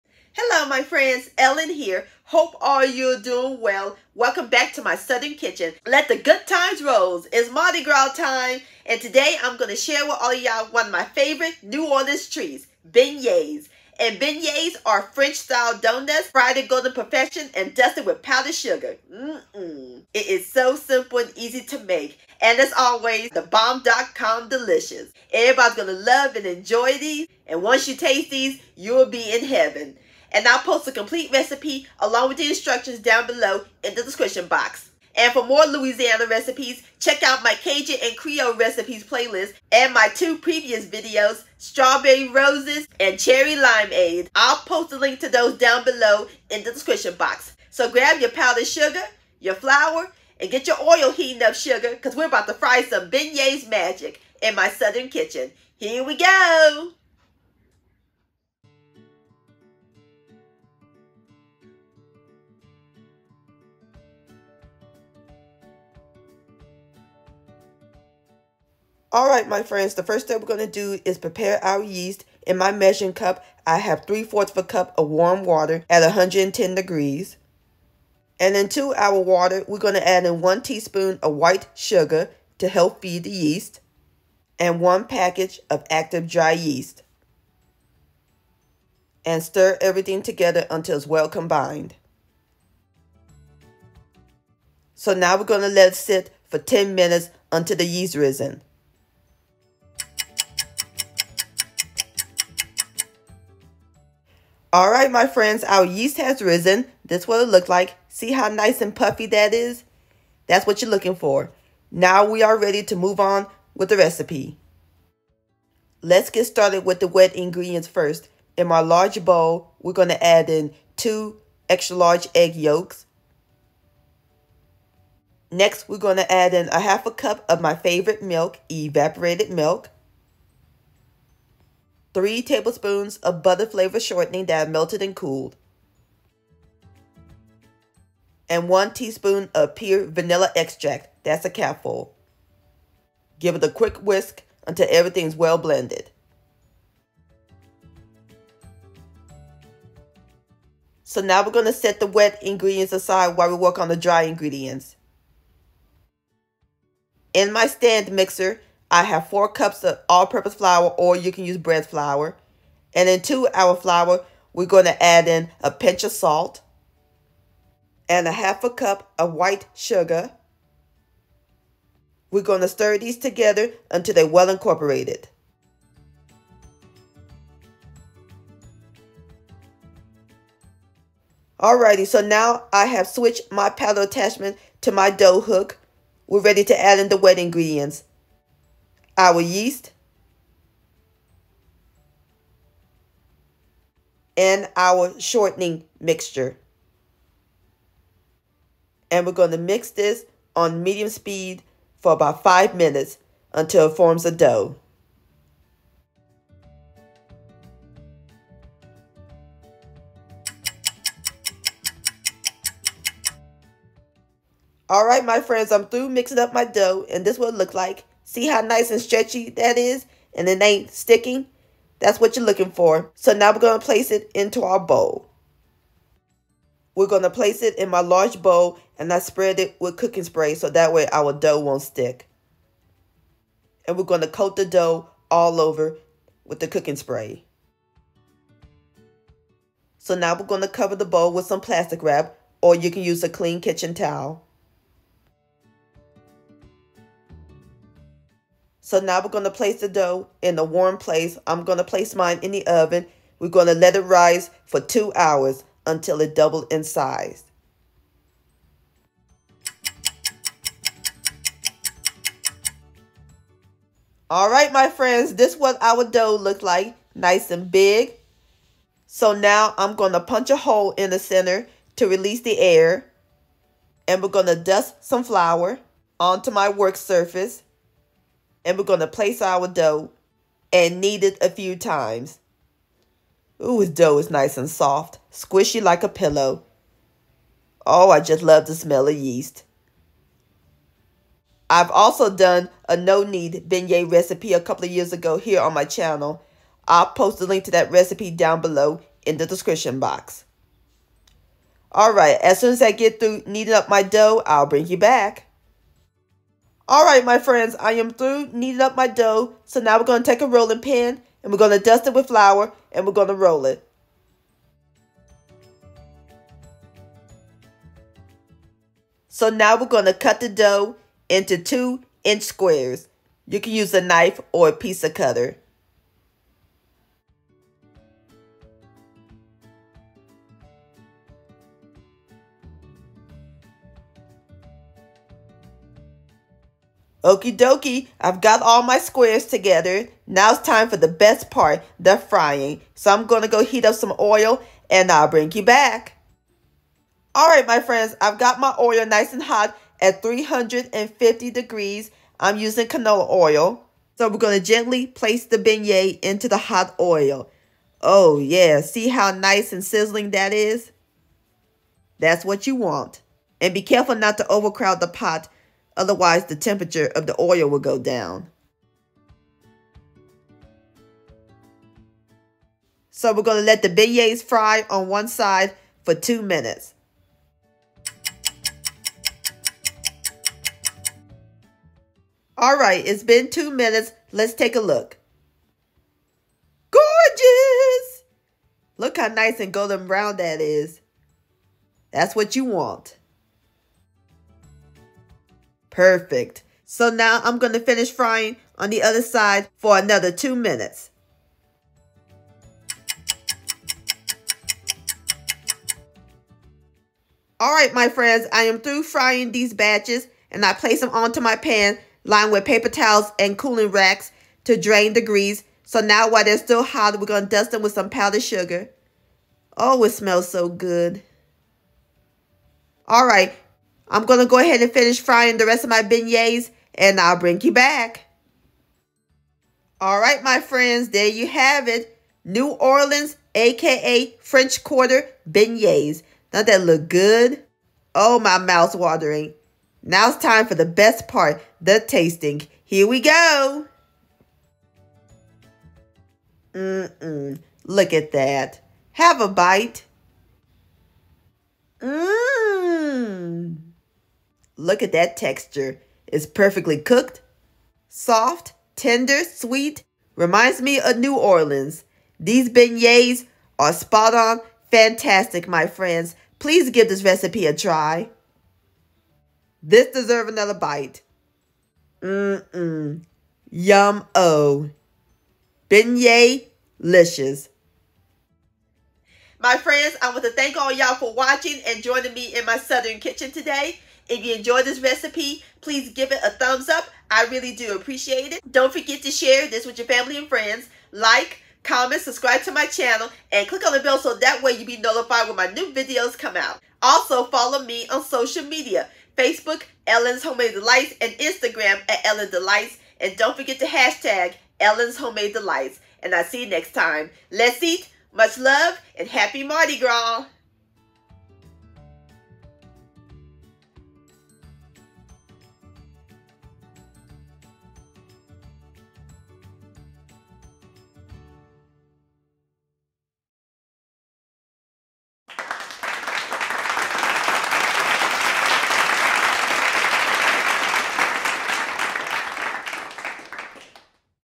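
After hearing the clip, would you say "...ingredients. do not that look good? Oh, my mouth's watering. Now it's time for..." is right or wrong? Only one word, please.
wrong.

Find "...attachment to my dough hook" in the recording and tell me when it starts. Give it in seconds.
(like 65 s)
184 s.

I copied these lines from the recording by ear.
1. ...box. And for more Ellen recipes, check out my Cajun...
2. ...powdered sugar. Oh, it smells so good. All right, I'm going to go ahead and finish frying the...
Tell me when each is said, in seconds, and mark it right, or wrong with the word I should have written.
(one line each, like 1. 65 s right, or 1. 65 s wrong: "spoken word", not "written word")
1. 34 s wrong: "Louisiana", not "Ellen"
2. 418 s right.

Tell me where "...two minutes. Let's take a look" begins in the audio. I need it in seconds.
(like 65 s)
383 s.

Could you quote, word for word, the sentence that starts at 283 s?
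Ooh, his dough is nice and soft, squishy like a pillow.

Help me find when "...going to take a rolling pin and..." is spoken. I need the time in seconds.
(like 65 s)
310 s.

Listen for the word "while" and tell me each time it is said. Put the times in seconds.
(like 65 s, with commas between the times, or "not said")
153 s, 416 s.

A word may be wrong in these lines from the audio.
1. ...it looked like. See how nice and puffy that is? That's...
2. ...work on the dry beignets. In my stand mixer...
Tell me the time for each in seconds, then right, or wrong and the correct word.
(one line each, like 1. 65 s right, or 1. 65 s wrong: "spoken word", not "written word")
1. 107 s right
2. 153 s wrong: "ingredients", not "beignets".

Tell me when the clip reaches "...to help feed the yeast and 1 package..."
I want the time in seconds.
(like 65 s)
82 s.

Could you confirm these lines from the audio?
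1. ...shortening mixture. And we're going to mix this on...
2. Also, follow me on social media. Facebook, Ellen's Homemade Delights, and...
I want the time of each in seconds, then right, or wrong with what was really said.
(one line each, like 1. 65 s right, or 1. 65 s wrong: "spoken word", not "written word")
1. 195 s right
2. 497 s right.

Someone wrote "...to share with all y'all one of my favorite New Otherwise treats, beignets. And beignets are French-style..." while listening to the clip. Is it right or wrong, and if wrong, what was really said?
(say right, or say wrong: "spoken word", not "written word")
wrong: "Orleans", not "Otherwise".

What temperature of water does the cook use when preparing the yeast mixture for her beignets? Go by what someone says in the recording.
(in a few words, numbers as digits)
110 degrees.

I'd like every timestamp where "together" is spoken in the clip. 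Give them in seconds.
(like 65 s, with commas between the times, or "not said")
90 s, 173 s, 339 s.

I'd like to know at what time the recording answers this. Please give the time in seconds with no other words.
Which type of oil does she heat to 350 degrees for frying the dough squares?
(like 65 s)
352 s.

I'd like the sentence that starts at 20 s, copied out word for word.
It is so simple and easy to make.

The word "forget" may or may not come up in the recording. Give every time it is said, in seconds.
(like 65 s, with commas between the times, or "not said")
488 s, 503 s.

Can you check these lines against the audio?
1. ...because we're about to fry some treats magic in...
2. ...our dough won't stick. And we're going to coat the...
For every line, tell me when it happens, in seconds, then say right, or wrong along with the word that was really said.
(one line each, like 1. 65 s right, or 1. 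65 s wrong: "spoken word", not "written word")
1. 51 s wrong: "beignets", not "treats"
2. 231 s right.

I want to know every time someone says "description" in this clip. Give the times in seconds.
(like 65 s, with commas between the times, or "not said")
34 s, 46 s, 299 s.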